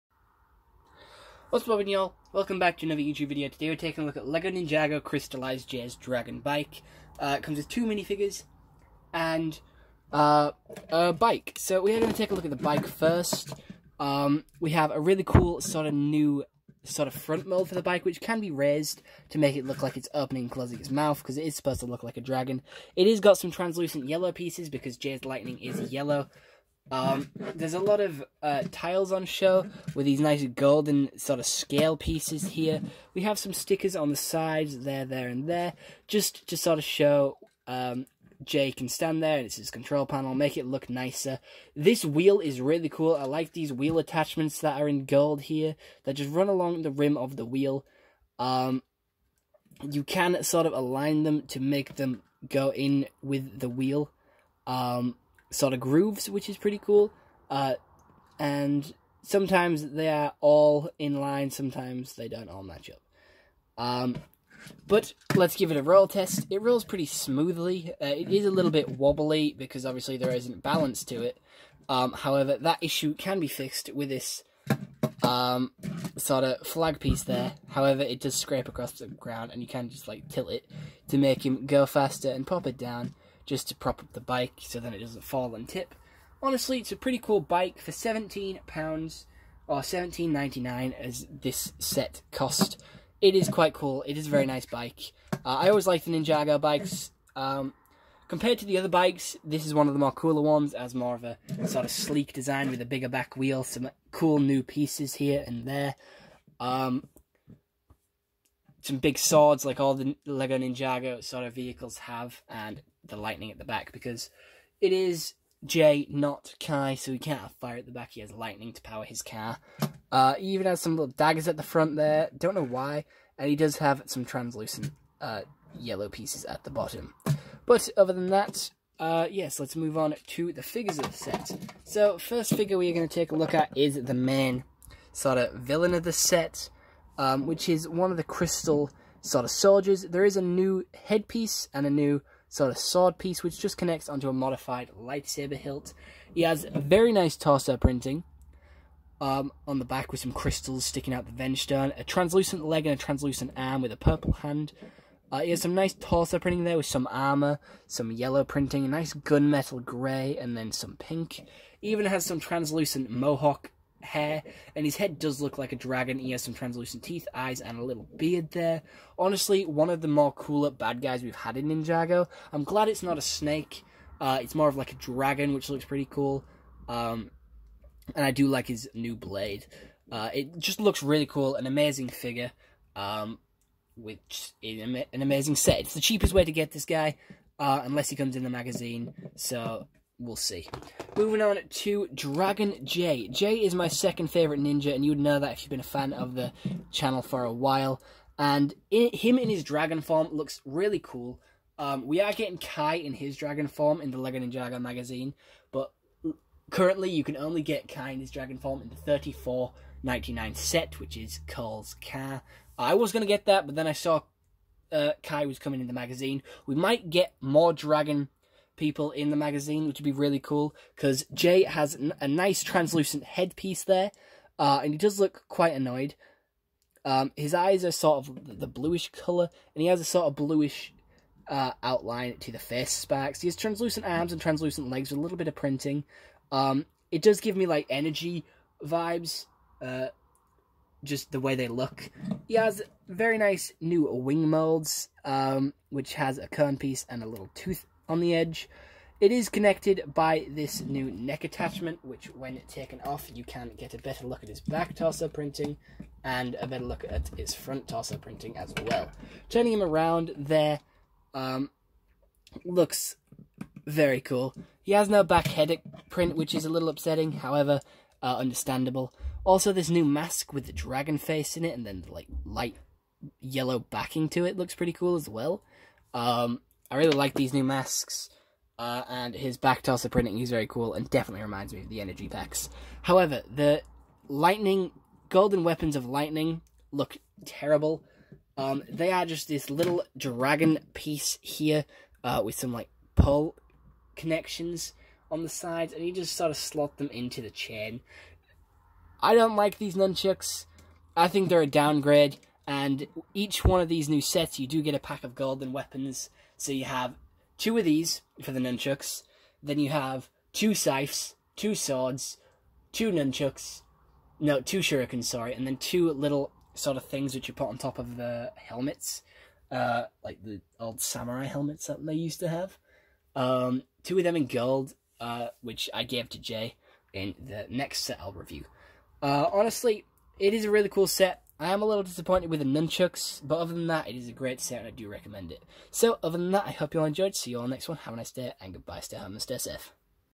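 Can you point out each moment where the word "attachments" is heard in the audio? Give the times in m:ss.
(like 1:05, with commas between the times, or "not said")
0:43, 4:11.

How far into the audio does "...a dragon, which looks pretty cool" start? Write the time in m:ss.
2:54.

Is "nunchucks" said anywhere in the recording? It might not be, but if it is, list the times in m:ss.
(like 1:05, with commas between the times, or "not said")
4:59, 5:08, 5:13, 5:32.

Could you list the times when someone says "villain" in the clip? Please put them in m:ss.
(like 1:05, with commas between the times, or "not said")
2:15.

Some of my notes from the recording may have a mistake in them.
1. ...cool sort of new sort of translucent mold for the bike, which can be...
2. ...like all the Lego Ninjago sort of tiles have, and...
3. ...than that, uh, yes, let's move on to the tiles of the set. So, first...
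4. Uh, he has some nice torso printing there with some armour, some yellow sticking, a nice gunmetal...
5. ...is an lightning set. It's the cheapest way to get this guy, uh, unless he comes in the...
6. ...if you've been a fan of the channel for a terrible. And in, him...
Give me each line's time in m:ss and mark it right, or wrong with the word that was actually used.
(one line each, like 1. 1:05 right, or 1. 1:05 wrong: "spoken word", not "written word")
1. 0:15 wrong: "front", not "translucent"
2. 1:49 wrong: "vehicles", not "tiles"
3. 2:08 wrong: "figures", not "tiles"
4. 2:35 wrong: "printing", not "sticking"
5. 3:04 wrong: "amazing", not "lightning"
6. 3:15 wrong: "while", not "terrible".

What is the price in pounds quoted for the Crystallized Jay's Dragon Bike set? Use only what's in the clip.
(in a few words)
£17.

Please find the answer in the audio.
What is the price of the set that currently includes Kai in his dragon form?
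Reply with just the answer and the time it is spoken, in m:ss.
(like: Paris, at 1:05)
$34.99, at 3:28.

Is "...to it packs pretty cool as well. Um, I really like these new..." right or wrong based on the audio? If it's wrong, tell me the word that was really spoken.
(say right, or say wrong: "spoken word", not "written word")
wrong: "looks", not "packs".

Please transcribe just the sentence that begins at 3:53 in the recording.
He has translucent arms and translucent legs with a little bit of printing.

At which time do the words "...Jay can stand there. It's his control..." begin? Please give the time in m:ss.
0:38.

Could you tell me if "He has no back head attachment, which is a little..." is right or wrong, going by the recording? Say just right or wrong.
wrong.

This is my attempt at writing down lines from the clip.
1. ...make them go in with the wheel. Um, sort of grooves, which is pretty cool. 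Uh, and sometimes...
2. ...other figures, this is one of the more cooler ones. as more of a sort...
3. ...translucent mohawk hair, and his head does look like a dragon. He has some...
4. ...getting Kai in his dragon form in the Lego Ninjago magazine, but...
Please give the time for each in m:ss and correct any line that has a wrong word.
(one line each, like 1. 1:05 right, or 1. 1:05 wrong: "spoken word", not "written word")
1. 0:51 right
2. 1:38 wrong: "bikes", not "figures"
3. 2:42 right
4. 3:22 right.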